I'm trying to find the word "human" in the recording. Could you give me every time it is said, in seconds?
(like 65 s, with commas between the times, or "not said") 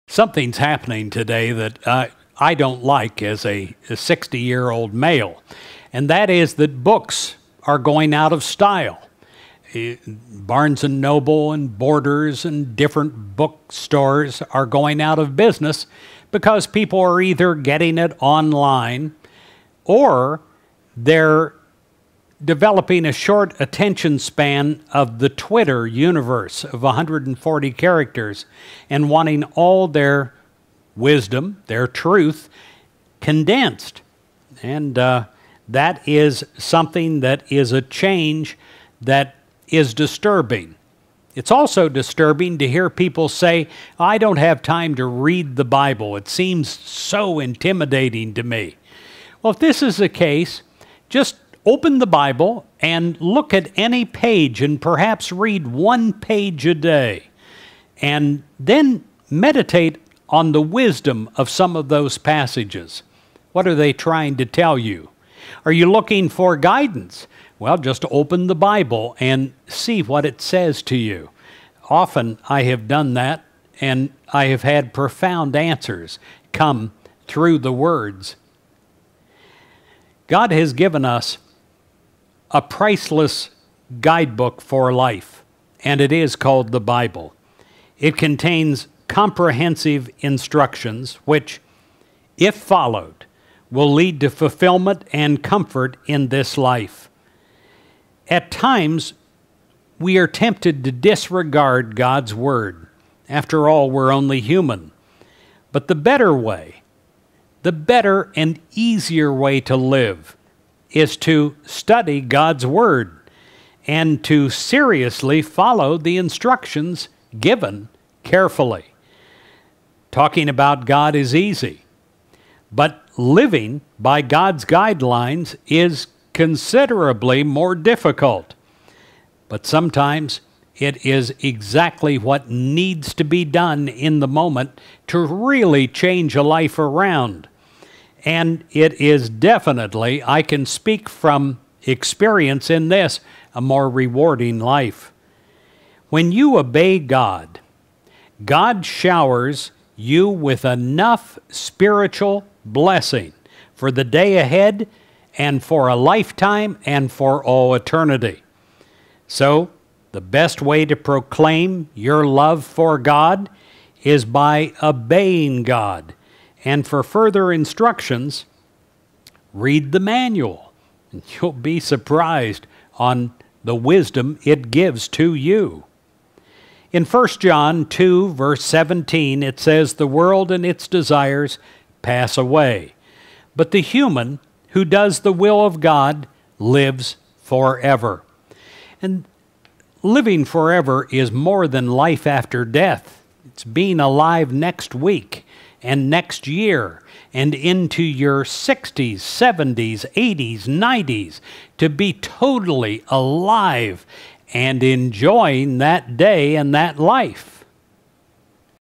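104 s, 183 s.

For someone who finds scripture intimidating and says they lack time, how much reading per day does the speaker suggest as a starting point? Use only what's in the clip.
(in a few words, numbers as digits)
one page.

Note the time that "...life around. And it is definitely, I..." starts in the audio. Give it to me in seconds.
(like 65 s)
136 s.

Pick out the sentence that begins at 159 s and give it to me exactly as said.
So, the best way to proclaim your love for God is by obeying God and for further instructions, read the manual.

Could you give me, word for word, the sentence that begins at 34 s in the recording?
And uh, that is something that is a change that is disturbing.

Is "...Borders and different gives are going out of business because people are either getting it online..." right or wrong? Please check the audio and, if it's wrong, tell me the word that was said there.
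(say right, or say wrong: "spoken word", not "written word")
wrong: "bookstores", not "gives".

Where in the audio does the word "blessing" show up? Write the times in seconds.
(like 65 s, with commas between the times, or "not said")
152 s.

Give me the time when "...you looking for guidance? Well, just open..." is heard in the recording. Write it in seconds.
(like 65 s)
65 s.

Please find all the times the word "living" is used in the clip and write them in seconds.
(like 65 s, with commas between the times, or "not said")
123 s, 190 s.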